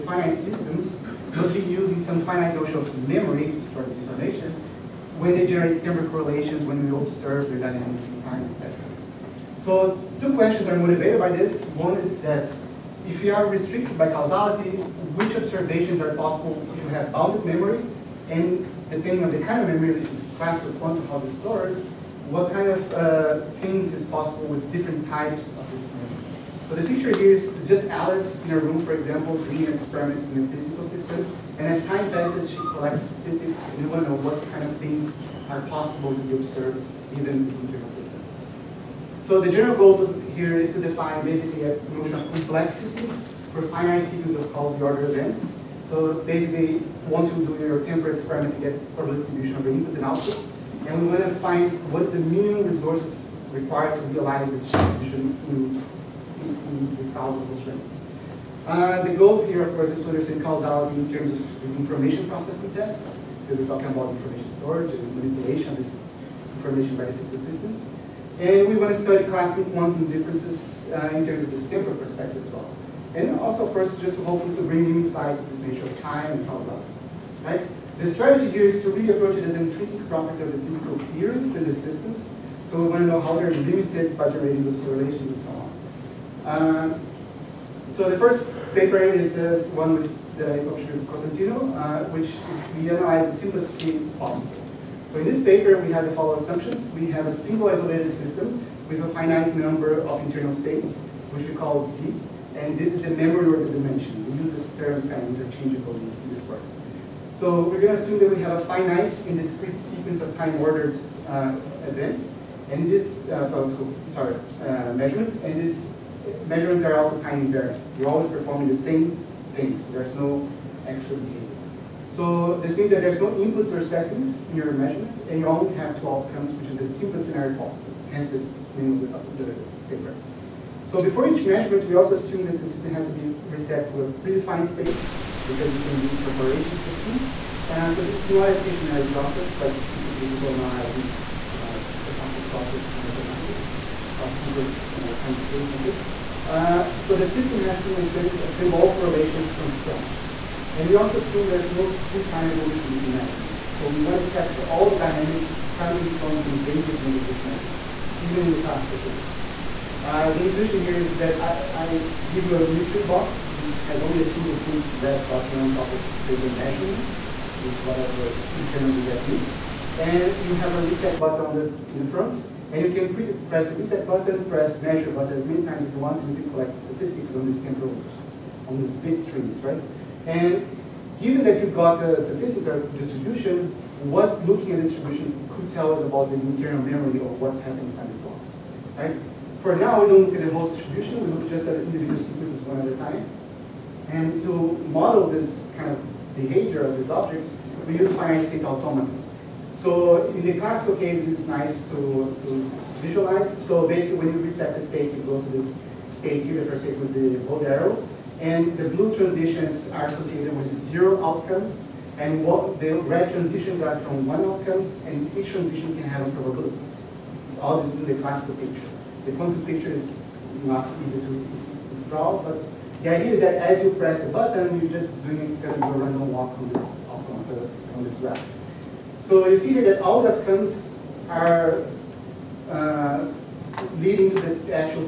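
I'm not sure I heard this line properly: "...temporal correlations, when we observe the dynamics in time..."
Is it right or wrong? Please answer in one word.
right.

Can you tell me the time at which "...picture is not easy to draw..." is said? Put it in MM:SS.
03:39.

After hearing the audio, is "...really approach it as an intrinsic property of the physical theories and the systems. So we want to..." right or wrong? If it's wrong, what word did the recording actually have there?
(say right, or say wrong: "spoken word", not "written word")
right.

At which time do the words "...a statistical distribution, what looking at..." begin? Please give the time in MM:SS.
03:02.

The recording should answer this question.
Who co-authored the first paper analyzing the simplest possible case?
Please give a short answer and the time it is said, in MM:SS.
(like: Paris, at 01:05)
Costantino, at 01:31.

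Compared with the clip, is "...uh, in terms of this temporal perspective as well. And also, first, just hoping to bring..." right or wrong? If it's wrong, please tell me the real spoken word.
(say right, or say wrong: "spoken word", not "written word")
right.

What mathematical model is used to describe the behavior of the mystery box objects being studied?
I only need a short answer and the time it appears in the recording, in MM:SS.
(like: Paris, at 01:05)
Finite state automata, at 03:18.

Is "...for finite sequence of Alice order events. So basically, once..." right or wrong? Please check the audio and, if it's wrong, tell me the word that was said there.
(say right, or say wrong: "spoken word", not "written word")
wrong: "Cauchy", not "Alice".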